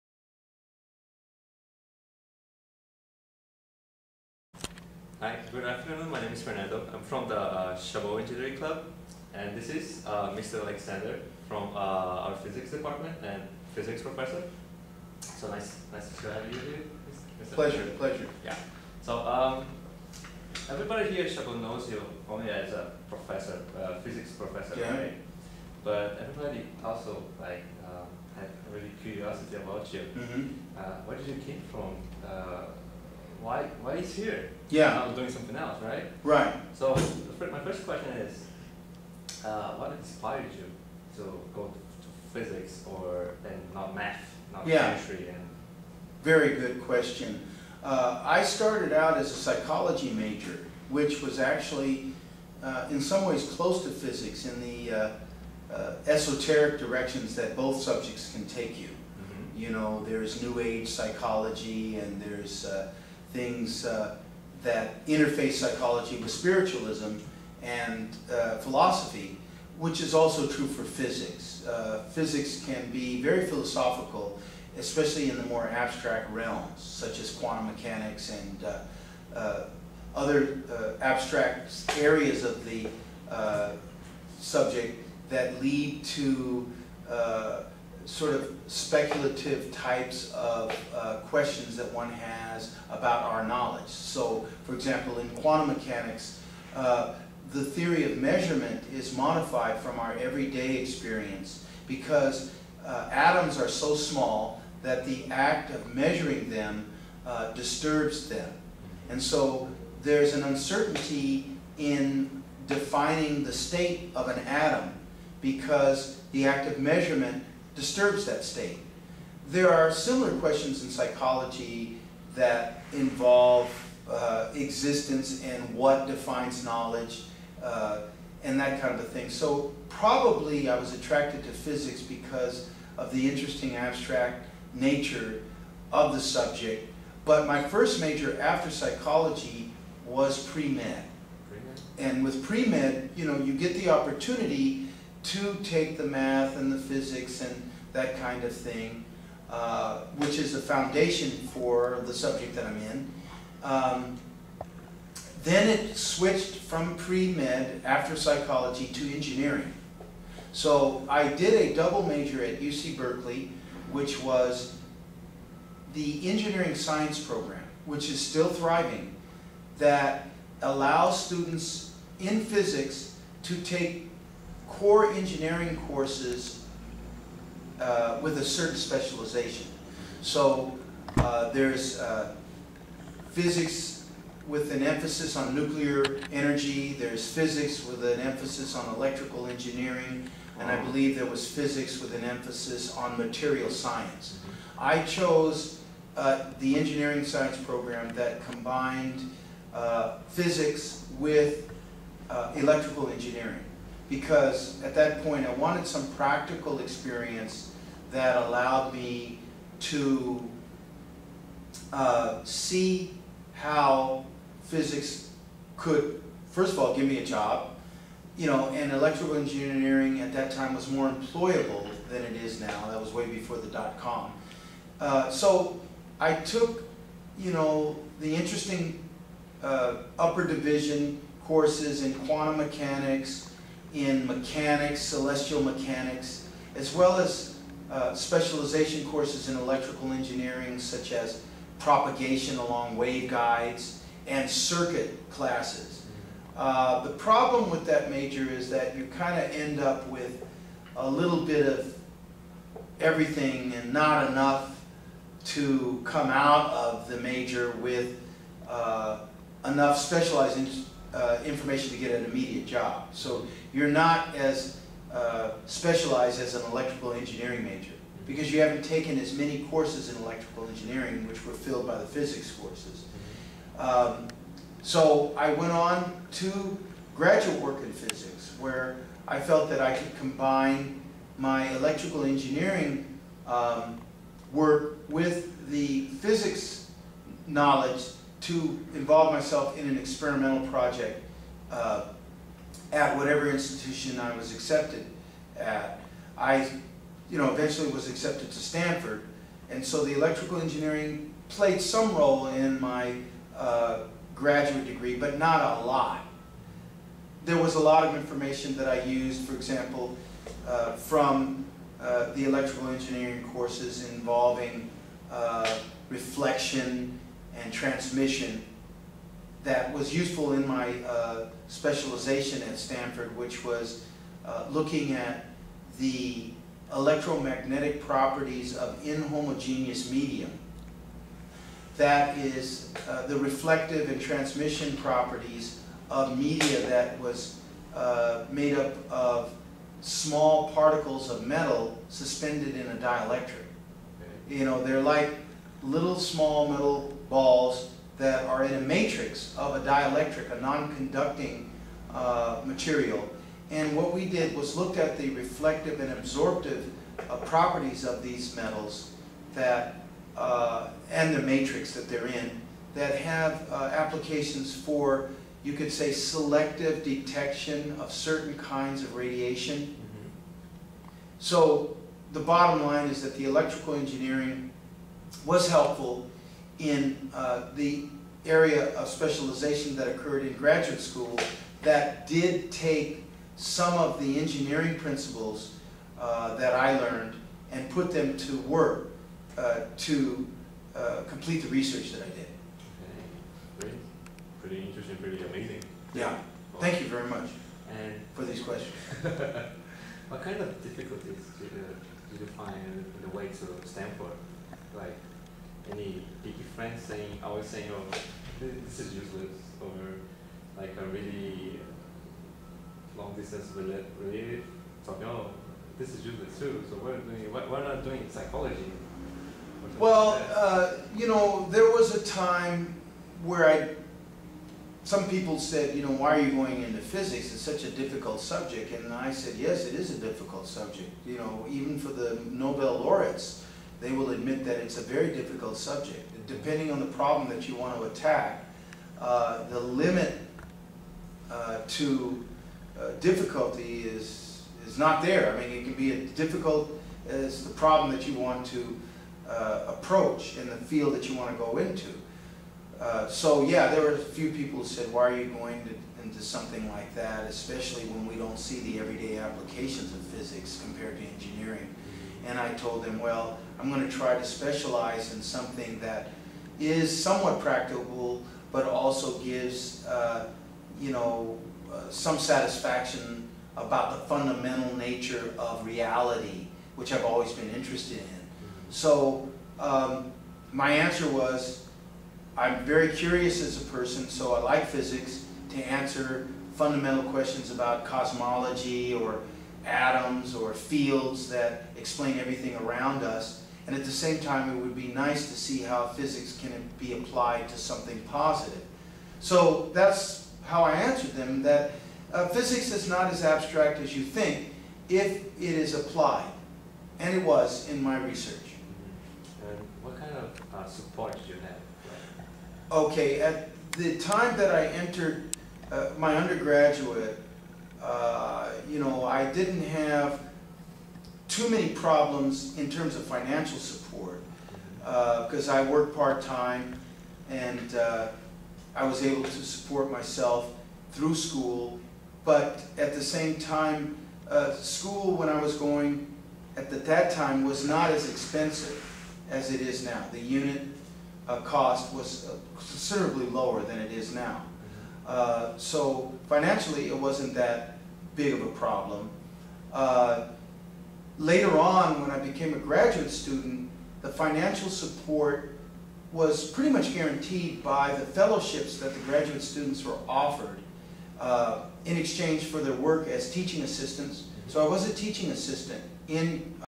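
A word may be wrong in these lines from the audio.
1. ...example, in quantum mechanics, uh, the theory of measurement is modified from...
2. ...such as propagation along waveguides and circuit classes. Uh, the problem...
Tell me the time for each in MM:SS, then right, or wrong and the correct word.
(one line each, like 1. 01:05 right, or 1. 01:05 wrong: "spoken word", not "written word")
1. 01:34 right
2. 04:00 right.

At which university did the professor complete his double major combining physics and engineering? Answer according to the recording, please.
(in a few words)
UC Berkeley.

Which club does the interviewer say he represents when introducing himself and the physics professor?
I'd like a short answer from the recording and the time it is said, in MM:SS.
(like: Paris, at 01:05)
Chabot Engineering Club, at 00:07.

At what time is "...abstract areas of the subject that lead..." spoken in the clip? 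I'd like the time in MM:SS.
01:21.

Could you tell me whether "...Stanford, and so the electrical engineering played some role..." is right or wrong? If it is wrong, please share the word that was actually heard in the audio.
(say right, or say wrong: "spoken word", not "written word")
right.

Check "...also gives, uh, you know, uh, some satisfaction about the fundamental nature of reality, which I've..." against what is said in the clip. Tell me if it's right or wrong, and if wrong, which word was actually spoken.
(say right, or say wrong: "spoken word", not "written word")
right.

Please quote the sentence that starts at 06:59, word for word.
Well, uh, you know, there was a time where I, some people said, you know, why are you going into physics?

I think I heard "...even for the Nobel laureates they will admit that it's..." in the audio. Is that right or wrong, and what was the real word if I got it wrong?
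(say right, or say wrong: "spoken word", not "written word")
right.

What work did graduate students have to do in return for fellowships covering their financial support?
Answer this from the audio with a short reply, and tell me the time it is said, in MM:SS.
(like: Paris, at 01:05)
teaching assistants, at 09:23.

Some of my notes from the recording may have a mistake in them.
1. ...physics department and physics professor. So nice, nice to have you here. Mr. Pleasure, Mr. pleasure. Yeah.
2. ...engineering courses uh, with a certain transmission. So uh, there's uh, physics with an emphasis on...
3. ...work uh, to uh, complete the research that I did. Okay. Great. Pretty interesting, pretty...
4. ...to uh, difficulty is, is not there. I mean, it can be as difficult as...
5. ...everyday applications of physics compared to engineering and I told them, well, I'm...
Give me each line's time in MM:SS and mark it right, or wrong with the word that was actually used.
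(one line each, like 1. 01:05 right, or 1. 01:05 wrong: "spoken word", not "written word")
1. 00:12 right
2. 02:55 wrong: "specialization", not "transmission"
3. 06:28 right
4. 07:21 right
5. 07:38 right.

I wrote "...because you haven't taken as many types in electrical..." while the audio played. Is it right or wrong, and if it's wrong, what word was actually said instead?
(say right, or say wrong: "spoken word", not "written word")
wrong: "courses", not "types".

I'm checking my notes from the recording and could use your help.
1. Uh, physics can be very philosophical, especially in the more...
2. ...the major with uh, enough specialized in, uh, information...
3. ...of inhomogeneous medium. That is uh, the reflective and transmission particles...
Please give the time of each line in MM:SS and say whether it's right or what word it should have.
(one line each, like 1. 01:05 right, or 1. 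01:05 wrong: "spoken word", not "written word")
1. 01:11 right
2. 04:17 right
3. 05:28 wrong: "properties", not "particles".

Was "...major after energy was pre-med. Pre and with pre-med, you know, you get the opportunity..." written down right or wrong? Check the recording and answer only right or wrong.
wrong.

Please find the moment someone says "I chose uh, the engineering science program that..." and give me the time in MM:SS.
03:14.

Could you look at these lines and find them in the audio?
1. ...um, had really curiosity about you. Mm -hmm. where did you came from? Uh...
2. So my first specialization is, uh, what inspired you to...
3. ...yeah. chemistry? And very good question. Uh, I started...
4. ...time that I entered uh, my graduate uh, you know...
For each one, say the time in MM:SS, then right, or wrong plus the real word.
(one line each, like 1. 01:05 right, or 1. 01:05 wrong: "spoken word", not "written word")
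1. 00:27 right
2. 00:36 wrong: "question", not "specialization"
3. 00:44 right
4. 08:34 wrong: "undergraduate", not "graduate".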